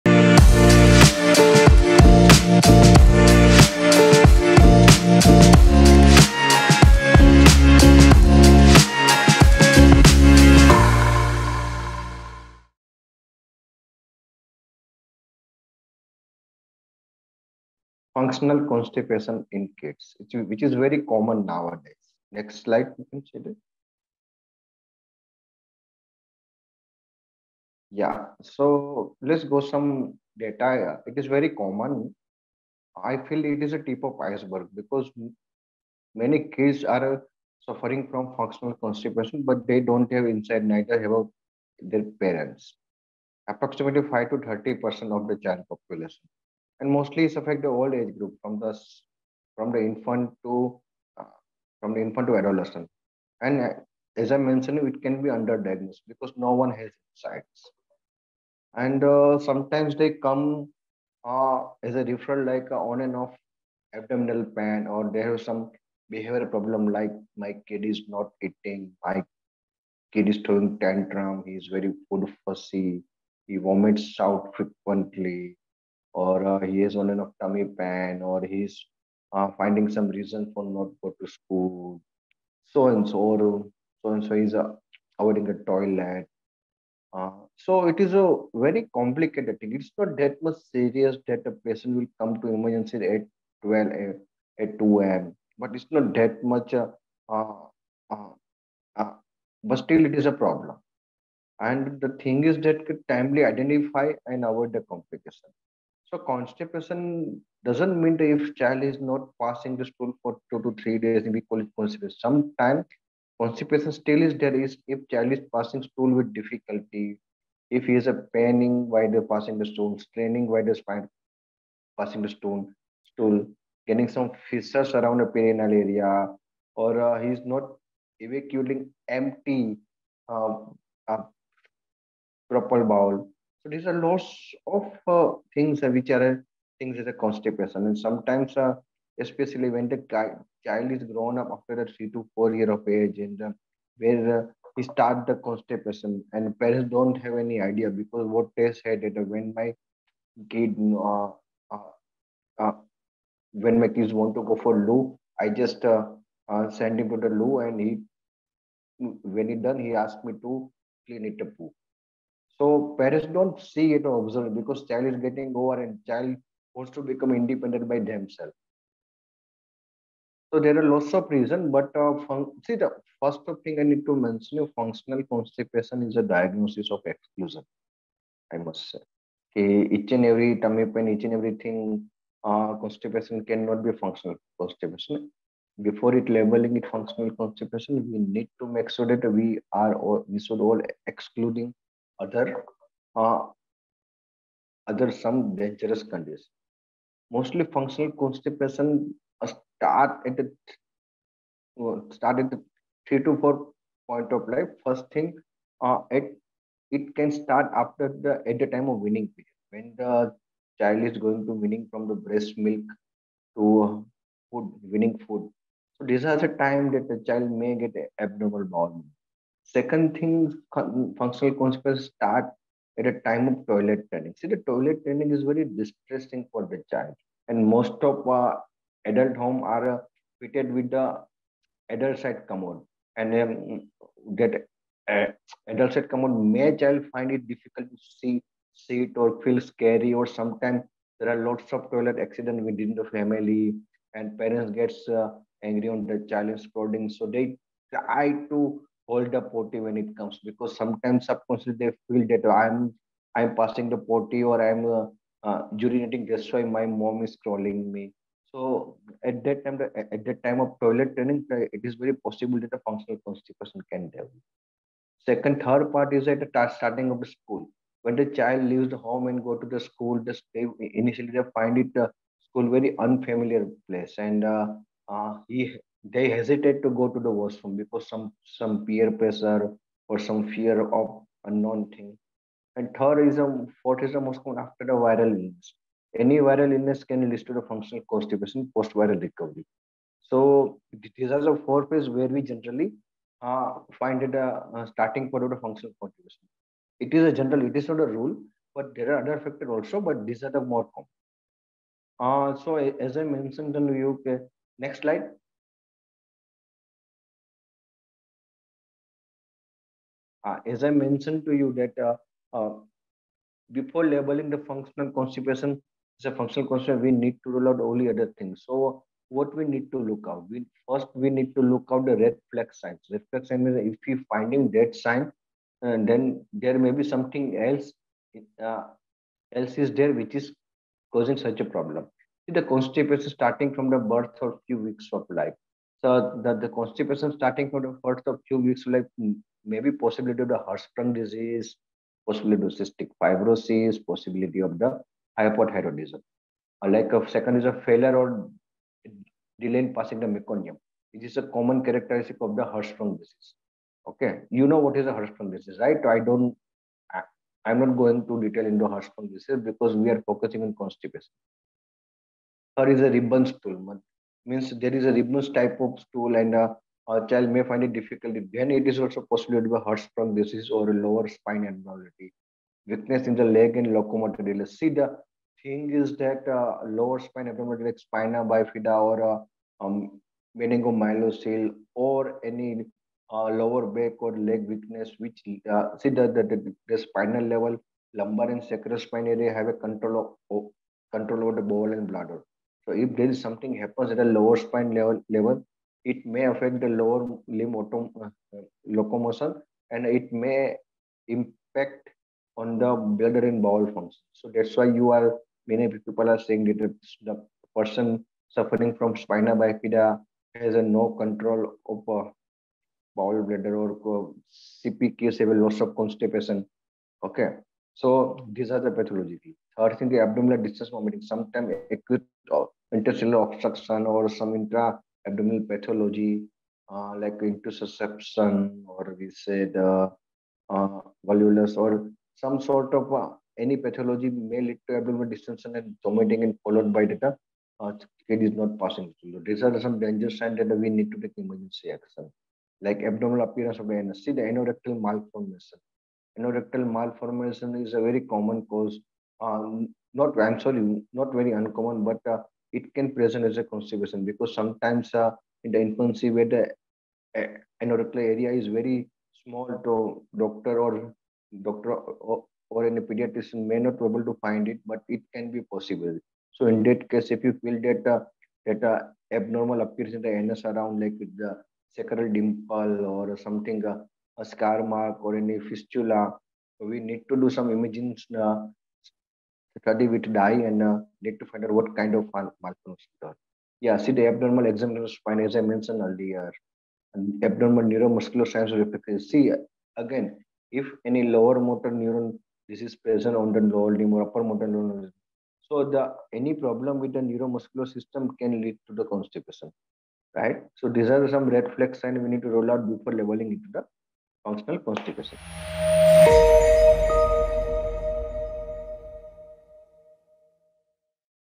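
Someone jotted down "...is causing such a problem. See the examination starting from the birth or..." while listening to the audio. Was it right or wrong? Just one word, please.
wrong.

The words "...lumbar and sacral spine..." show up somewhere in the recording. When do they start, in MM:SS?
06:28.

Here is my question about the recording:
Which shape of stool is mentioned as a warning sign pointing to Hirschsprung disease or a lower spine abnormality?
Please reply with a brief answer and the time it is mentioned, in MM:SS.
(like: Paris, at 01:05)
Ribbon stool, at 06:03.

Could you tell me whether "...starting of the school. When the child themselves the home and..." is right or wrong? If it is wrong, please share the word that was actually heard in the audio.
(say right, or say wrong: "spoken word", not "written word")
wrong: "leaves", not "themselves".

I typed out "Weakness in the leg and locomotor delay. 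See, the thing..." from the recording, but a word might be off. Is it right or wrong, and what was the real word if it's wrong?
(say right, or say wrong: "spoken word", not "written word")
right.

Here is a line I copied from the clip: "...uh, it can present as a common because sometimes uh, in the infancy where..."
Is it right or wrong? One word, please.
wrong.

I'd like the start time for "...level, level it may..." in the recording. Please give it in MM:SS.
06:34.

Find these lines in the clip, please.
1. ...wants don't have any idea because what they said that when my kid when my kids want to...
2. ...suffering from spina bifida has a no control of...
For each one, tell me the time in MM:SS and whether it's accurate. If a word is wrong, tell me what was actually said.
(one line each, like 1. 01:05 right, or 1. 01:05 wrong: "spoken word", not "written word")
1. 02:26 wrong: "parents", not "wants"
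2. 06:48 right.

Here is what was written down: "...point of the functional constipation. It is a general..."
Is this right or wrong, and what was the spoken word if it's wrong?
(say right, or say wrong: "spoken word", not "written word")
right.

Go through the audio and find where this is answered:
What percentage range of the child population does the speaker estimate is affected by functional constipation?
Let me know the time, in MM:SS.
00:44.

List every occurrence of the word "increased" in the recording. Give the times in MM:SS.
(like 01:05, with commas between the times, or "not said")
not said.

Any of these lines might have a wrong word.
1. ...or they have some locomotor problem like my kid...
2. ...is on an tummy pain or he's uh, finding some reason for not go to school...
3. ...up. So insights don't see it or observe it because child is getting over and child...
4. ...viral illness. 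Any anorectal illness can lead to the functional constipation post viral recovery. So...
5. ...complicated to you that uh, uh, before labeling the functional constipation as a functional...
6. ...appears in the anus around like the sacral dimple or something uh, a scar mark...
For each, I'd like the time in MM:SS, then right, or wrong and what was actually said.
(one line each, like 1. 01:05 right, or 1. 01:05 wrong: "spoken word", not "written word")
1. 01:04 wrong: "behavior", not "locomotor"
2. 01:16 right
3. 02:41 wrong: "parents", not "insights"
4. 04:44 wrong: "viral", not "anorectal"
5. 05:10 wrong: "mentioned", not "complicated"
6. 07:49 right.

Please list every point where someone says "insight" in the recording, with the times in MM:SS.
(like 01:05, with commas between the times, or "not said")
00:40, 00:57.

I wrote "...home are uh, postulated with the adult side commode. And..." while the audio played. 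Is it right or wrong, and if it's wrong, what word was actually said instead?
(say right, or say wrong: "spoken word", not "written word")
wrong: "fitted", not "postulated".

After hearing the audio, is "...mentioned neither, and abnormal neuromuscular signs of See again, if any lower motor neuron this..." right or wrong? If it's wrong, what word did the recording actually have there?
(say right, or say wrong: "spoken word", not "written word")
wrong: "earlier", not "neither".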